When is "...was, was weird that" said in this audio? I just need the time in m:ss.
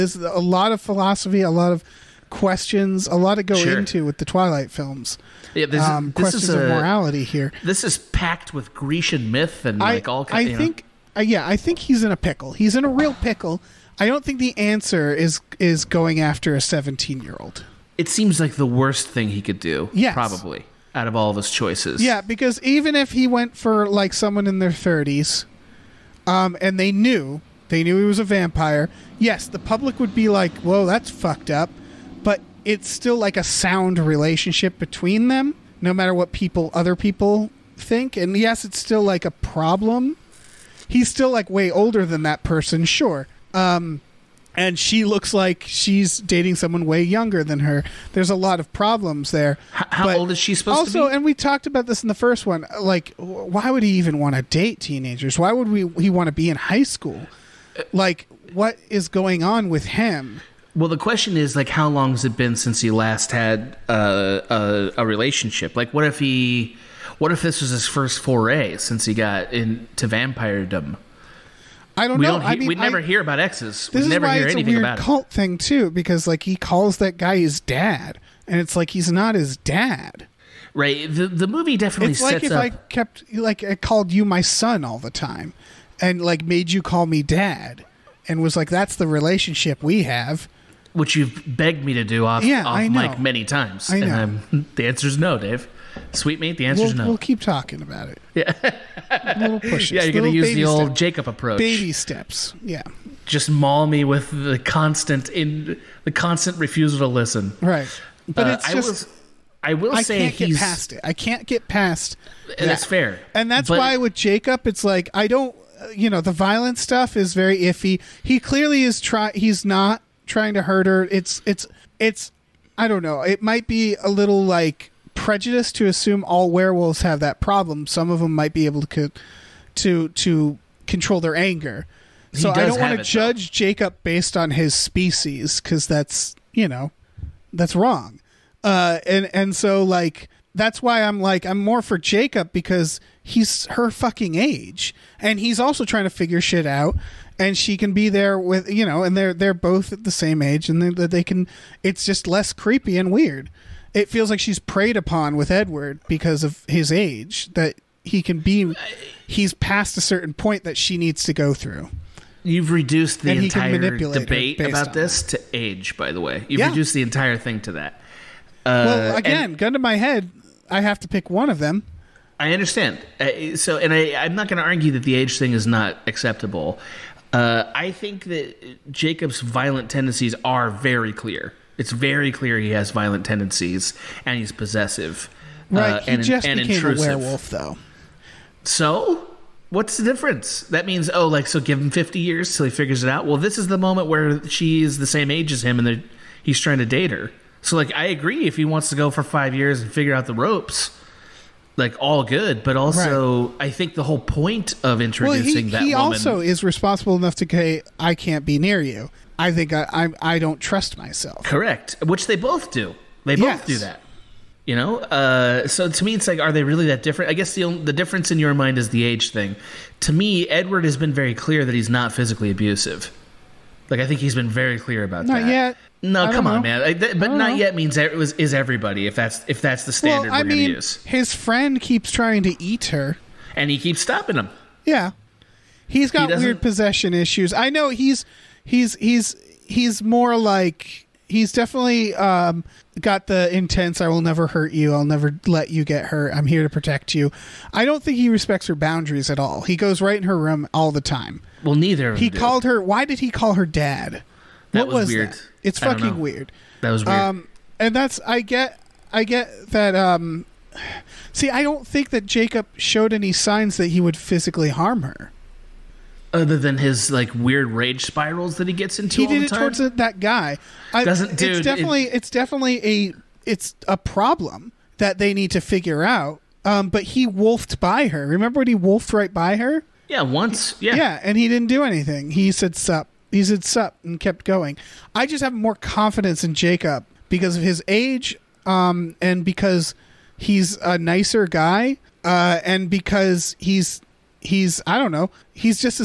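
4:14.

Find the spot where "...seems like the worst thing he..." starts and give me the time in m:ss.
0:18.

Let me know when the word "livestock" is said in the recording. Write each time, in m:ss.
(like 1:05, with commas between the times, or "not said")
not said.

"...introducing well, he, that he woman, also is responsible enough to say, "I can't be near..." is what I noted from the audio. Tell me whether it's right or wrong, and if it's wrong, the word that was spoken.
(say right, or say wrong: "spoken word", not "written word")
right.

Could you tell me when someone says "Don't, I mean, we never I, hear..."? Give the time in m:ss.
1:12.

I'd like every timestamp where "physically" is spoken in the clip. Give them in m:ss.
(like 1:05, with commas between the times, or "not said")
3:42, 4:24.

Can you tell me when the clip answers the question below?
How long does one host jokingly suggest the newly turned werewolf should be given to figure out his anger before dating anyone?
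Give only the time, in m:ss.
3:11.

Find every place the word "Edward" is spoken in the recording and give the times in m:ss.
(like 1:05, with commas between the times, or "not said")
2:35, 3:40.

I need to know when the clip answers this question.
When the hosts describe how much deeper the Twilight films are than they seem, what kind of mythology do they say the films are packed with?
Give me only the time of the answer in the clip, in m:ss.
0:08.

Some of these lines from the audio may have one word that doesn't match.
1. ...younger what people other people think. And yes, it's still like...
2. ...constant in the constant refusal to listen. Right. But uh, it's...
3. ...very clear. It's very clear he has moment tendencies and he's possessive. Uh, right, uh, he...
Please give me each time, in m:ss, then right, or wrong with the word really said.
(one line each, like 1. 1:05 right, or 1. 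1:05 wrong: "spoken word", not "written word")
1. 0:35 wrong: "matter", not "younger"
2. 1:44 right
3. 3:00 wrong: "violent", not "moment".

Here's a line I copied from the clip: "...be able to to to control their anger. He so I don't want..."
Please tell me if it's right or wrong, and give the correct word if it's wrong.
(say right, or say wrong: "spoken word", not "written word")
right.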